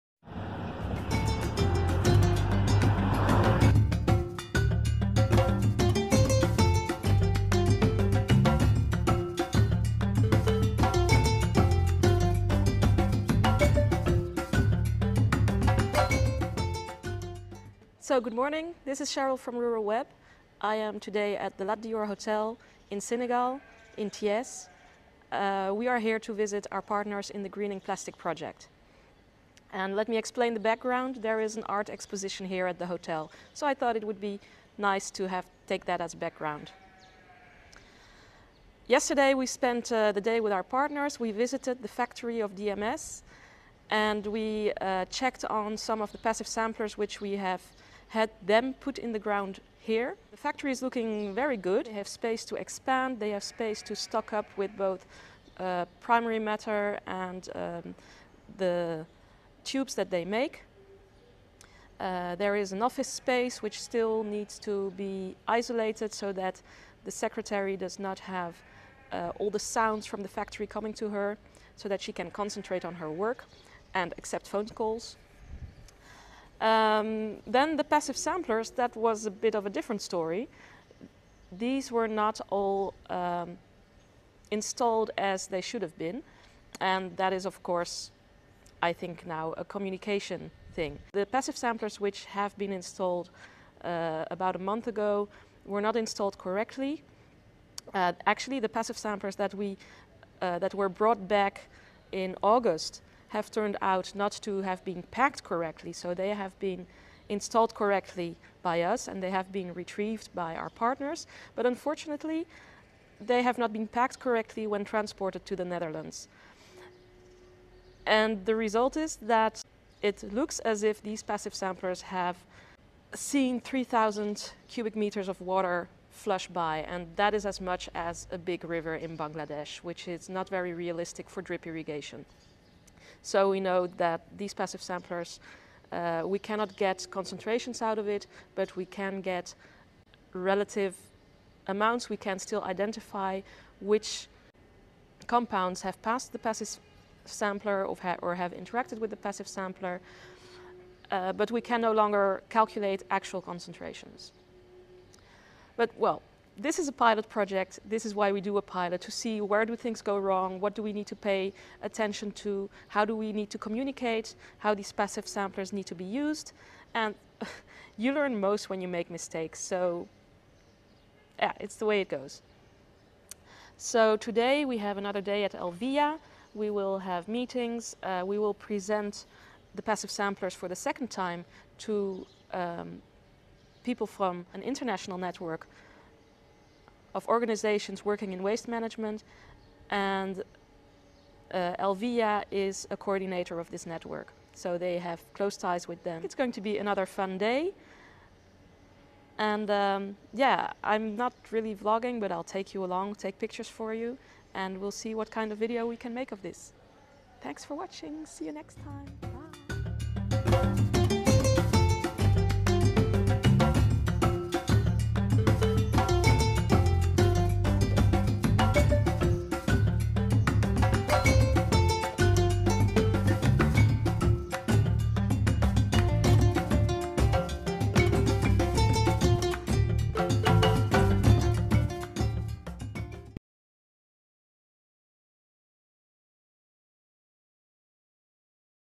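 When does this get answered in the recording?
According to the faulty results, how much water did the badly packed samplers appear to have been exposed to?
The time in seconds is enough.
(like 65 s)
123 s.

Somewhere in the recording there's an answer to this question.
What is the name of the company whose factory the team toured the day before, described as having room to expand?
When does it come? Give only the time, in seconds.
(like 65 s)
42 s.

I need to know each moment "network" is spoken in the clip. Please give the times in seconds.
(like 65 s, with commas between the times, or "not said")
185 s, 193 s.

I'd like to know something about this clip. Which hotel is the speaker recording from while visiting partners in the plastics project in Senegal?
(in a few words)
Lat Dior Hotel.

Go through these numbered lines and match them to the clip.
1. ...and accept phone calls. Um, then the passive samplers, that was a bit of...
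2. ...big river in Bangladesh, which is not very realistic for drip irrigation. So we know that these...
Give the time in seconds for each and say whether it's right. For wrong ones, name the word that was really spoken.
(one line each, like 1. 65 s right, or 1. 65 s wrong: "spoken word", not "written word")
1. 73 s right
2. 128 s right.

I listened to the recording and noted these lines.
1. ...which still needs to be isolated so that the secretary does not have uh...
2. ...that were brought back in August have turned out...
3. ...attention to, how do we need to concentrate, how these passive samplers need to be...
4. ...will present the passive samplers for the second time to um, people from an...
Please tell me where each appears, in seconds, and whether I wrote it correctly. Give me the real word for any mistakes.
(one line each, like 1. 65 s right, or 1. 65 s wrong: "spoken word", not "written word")
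1. 63 s right
2. 100 s right
3. 161 s wrong: "communicate", not "concentrate"
4. 178 s right.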